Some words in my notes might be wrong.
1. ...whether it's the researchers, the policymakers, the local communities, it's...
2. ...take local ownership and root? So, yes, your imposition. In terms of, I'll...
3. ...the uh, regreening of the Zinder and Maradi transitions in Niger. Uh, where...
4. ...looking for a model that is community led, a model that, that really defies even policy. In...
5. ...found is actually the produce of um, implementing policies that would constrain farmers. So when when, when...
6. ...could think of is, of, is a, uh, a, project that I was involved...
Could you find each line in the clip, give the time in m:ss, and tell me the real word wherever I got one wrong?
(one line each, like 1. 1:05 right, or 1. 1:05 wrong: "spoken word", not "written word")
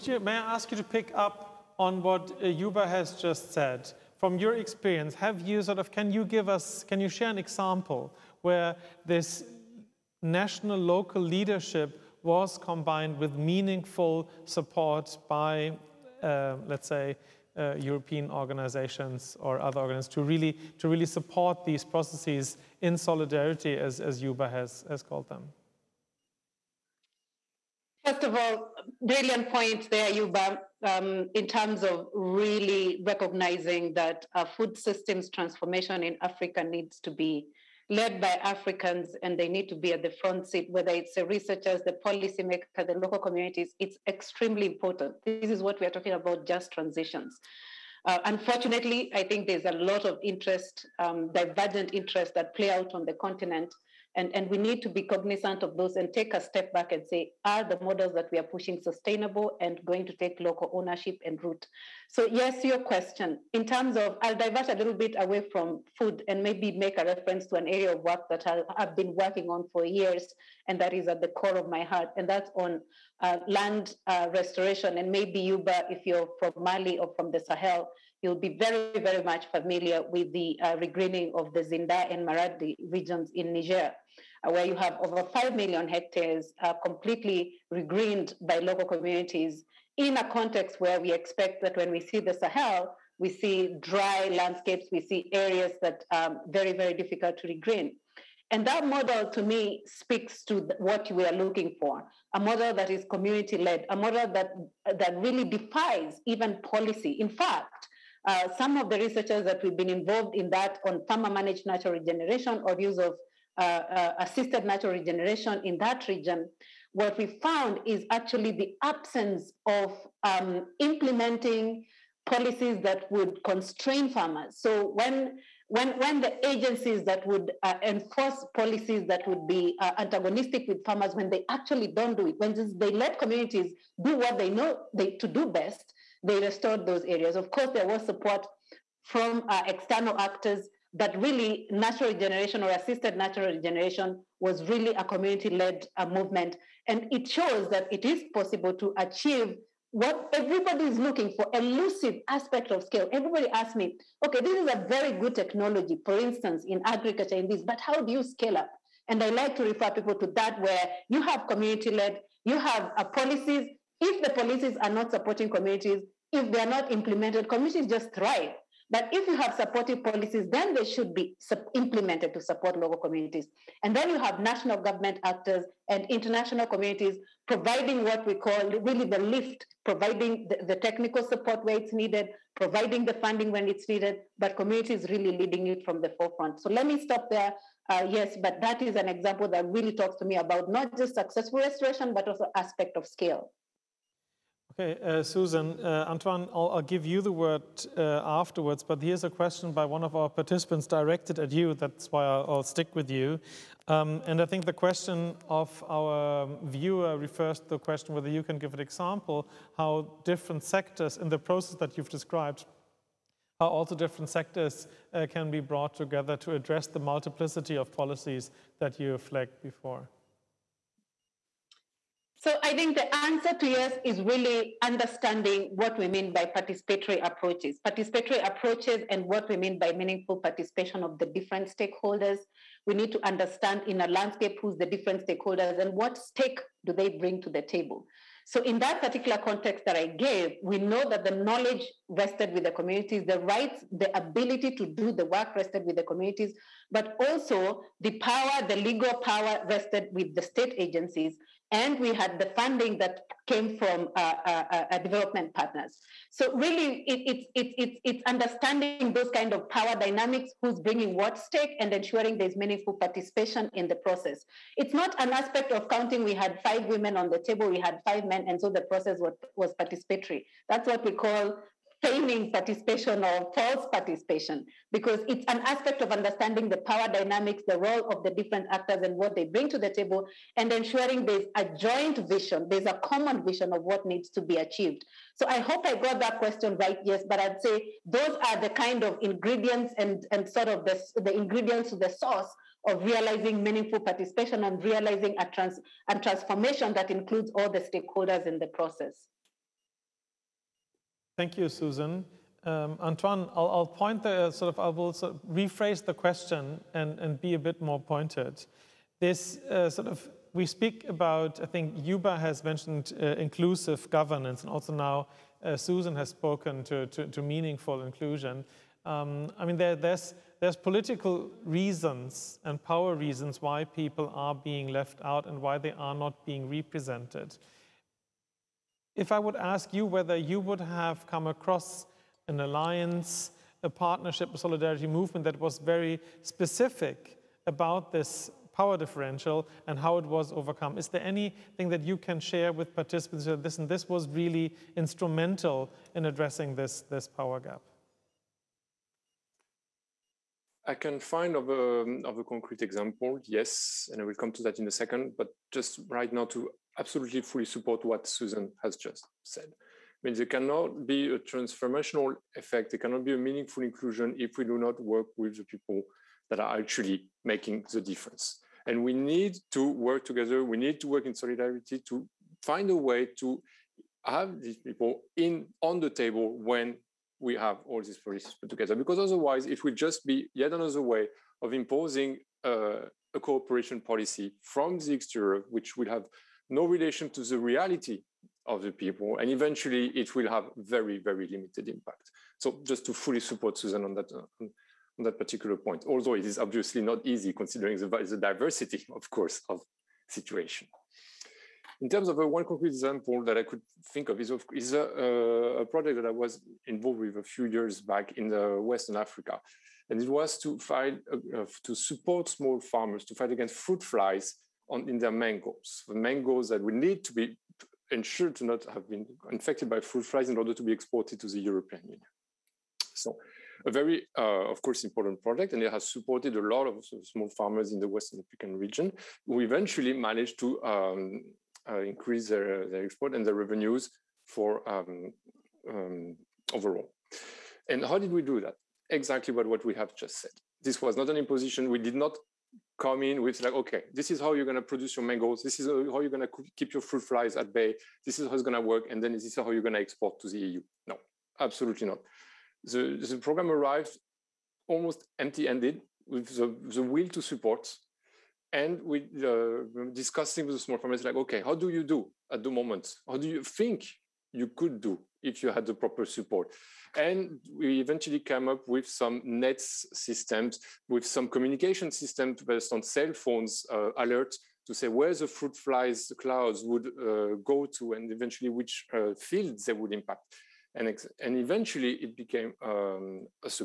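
1. 0:40 right
2. 1:00 wrong: "question", not "imposition"
3. 1:20 wrong: "regions", not "transitions"
4. 1:41 right
5. 1:57 wrong: "absence", not "produce"
6. 6:43 right.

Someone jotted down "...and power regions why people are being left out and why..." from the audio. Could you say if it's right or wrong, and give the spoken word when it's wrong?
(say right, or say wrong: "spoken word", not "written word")
wrong: "reasons", not "regions".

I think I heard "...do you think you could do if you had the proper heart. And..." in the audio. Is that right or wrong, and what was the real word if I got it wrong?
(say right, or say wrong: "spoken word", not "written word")
wrong: "support", not "heart".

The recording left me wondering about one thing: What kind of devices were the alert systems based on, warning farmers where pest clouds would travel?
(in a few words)
cell phones.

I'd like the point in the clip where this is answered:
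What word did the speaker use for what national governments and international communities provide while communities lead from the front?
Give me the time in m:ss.
2:59.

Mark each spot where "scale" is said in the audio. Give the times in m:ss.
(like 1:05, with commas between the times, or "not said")
2:32, 2:38, 3:13.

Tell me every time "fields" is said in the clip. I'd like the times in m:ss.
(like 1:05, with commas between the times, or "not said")
7:59.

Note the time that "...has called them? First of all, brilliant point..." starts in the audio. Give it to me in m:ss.
0:24.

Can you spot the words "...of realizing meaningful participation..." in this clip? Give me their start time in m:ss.
4:52.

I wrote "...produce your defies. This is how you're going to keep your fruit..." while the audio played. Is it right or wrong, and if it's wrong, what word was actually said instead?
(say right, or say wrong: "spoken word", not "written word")
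wrong: "mangoes", not "defies".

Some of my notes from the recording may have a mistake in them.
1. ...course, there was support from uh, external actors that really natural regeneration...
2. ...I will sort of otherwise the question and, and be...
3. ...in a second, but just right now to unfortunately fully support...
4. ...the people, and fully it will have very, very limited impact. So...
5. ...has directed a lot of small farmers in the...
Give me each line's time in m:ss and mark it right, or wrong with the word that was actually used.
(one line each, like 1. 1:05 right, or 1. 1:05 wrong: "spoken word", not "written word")
1. 2:17 right
2. 5:04 wrong: "rephrase", not "otherwise"
3. 5:54 wrong: "absolutely", not "unfortunately"
4. 6:28 wrong: "eventually", not "fully"
5. 7:05 wrong: "supported", not "directed".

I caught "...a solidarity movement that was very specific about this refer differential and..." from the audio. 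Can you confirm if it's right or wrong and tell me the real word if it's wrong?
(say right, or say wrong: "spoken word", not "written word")
wrong: "power", not "refer".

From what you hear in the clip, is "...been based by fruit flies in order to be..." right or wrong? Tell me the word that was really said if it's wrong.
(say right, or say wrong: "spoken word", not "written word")
wrong: "infected", not "based".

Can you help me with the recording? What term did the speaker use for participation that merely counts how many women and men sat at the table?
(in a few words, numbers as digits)
feigning participation.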